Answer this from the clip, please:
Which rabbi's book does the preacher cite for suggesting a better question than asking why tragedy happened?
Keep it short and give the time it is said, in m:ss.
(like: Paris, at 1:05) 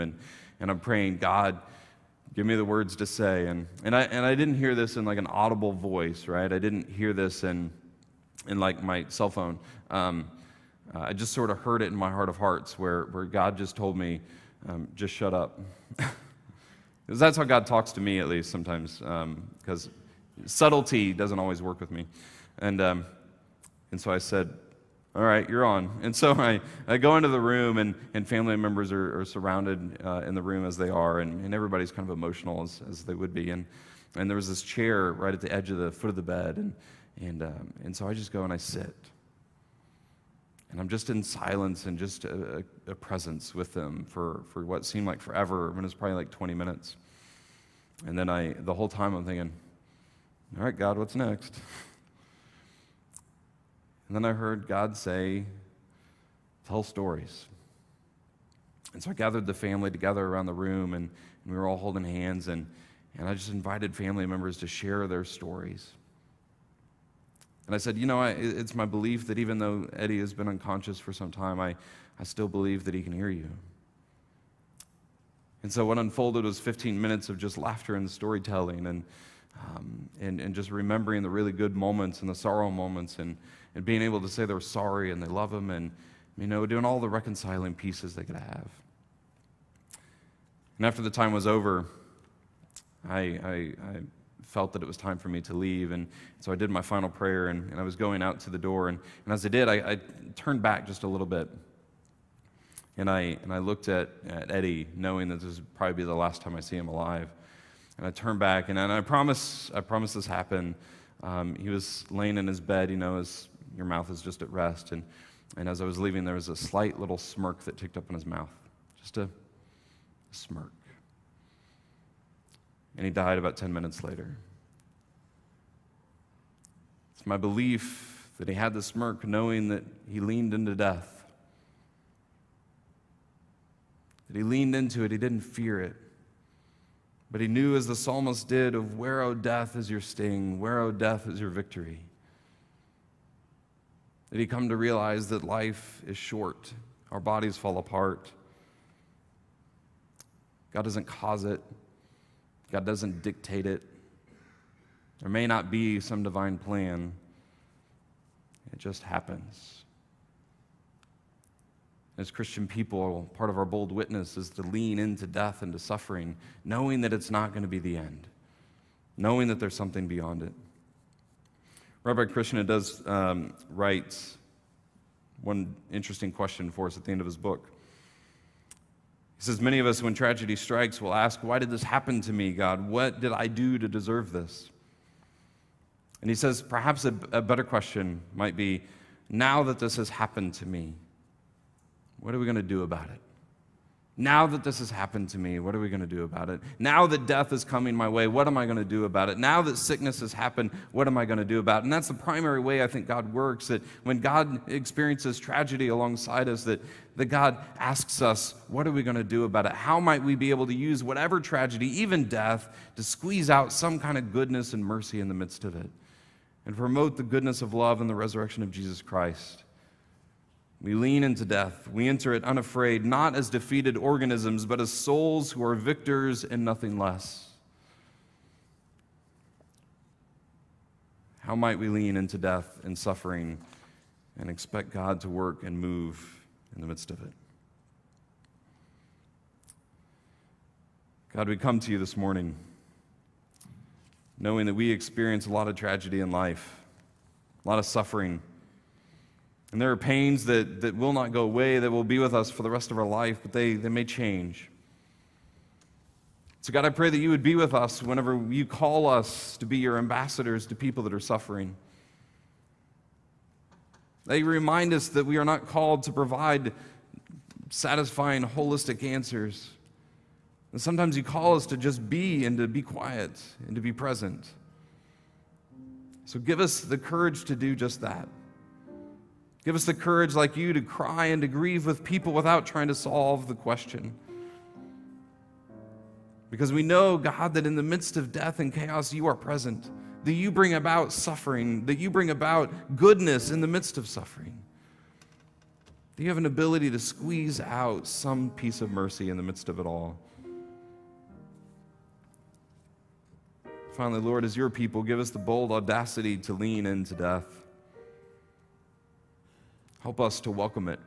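Rabbi Kushner, at 2:52.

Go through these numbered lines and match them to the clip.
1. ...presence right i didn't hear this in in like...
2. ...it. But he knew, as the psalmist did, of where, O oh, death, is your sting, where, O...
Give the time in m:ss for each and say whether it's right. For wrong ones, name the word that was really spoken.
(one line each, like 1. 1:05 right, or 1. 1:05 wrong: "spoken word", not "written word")
1. 0:05 wrong: "voice", not "presence"
2. 2:15 right.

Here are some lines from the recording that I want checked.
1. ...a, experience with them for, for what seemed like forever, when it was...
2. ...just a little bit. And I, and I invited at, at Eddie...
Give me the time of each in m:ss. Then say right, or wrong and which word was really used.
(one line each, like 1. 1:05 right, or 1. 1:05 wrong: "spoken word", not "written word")
1. 0:42 wrong: "presence", not "experience"
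2. 1:40 wrong: "looked", not "invited".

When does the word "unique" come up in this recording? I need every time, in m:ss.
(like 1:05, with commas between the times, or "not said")
not said.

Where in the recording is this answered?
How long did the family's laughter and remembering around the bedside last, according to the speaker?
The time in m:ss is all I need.
1:16.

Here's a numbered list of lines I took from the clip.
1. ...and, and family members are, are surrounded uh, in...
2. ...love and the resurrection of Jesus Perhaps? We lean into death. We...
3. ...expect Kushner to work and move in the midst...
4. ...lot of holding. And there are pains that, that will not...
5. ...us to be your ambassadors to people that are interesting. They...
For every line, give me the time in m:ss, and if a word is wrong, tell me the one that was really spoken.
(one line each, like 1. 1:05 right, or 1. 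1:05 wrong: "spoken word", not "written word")
1. 0:27 right
2. 3:37 wrong: "Christ", not "Perhaps"
3. 3:54 wrong: "God", not "Kushner"
4. 4:07 wrong: "suffering", not "holding"
5. 4:19 wrong: "suffering", not "interesting".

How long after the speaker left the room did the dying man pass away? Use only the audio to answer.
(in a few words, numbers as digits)
10 minutes.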